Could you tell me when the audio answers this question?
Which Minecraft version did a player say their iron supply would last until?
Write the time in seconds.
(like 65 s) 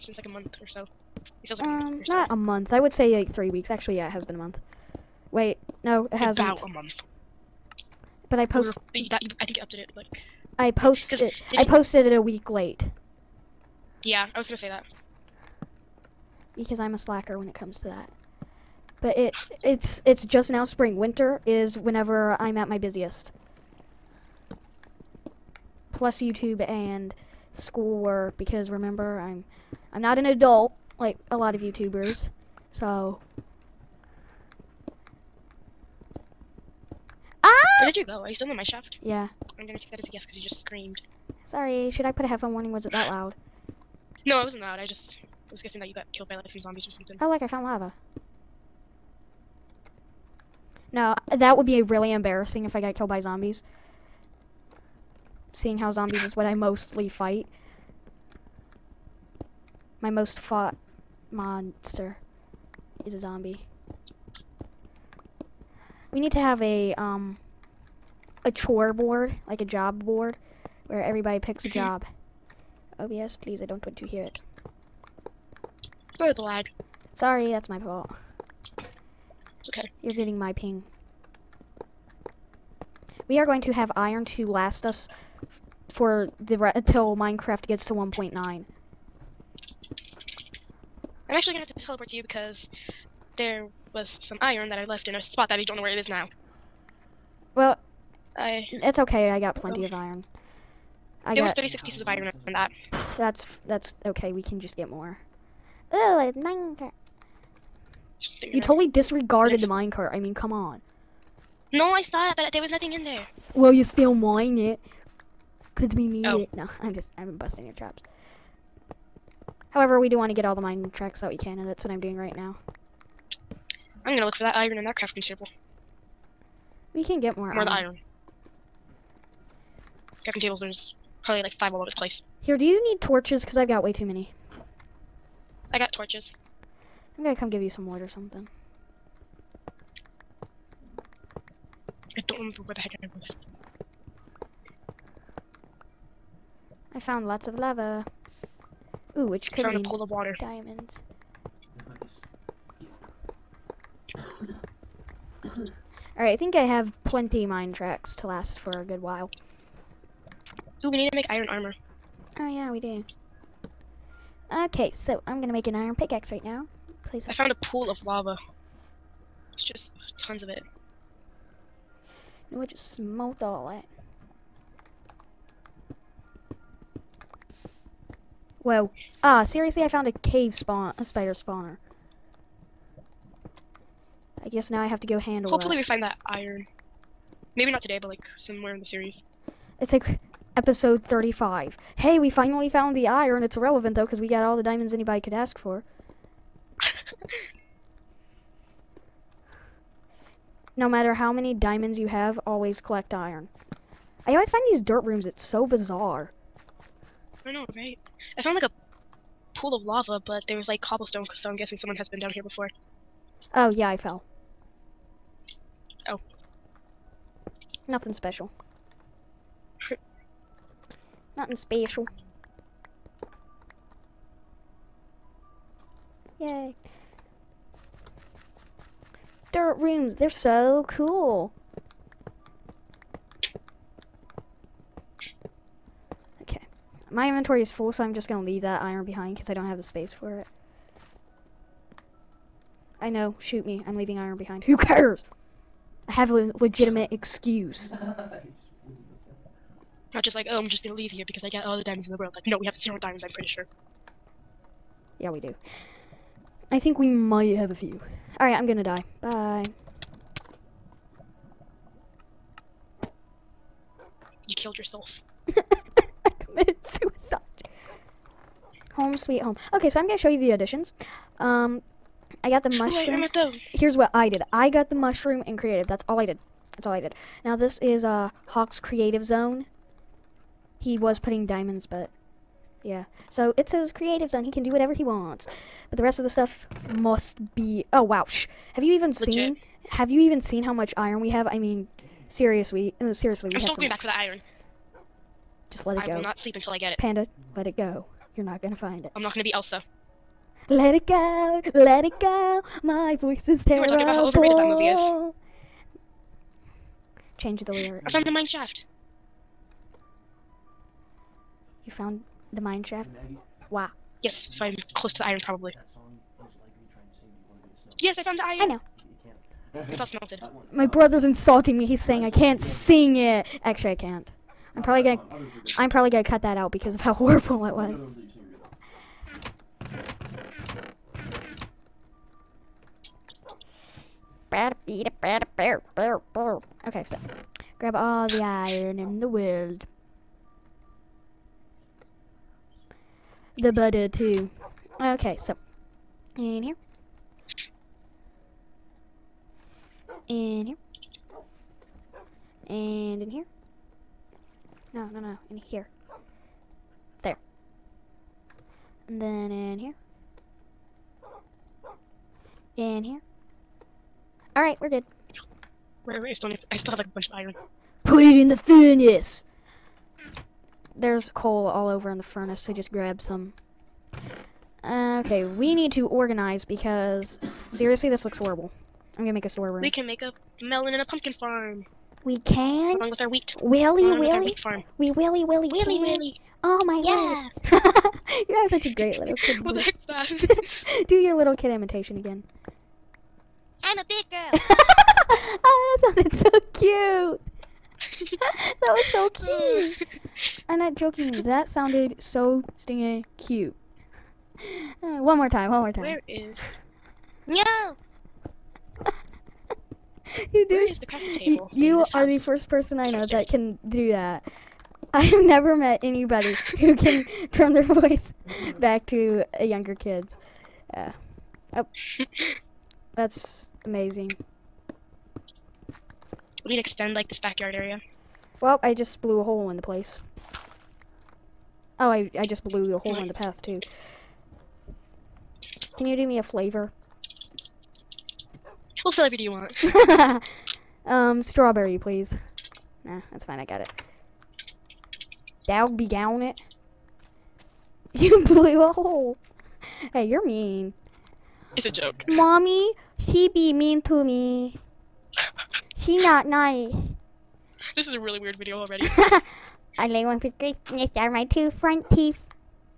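87 s.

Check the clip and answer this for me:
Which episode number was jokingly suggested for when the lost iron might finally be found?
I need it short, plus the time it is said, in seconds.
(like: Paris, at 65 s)
35, at 190 s.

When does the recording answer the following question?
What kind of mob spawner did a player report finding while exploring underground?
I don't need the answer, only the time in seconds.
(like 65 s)
180 s.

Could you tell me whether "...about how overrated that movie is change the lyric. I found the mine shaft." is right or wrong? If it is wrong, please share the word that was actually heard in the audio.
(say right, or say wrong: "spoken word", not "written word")
right.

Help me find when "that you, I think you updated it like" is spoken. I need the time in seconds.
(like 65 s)
9 s.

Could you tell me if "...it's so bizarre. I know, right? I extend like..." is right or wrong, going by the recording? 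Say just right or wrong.
wrong.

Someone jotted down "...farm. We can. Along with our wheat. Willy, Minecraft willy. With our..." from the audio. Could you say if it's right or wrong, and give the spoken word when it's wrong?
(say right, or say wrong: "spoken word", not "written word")
wrong: "Along", not "Minecraft".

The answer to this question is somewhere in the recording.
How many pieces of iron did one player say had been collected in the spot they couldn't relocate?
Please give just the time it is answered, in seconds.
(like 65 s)
101 s.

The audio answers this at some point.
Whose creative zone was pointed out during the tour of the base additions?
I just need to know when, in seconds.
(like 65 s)
278 s.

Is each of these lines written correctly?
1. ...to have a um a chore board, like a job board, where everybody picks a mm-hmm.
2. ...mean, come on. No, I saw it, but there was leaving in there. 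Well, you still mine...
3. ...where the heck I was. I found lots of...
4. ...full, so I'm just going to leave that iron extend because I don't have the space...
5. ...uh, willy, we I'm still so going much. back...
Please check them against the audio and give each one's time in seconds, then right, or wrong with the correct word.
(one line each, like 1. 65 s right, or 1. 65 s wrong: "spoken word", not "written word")
1. 66 s right
2. 110 s wrong: "nothing", not "leaving"
3. 142 s right
4. 237 s wrong: "behind", not "extend"
5. 293 s wrong: "seriously", not "willy".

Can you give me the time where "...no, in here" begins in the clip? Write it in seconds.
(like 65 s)
355 s.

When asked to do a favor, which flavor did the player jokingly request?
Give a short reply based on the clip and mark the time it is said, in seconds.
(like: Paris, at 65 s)
Strawberry, at 441 s.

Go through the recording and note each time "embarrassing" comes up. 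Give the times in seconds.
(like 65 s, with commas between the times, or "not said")
52 s.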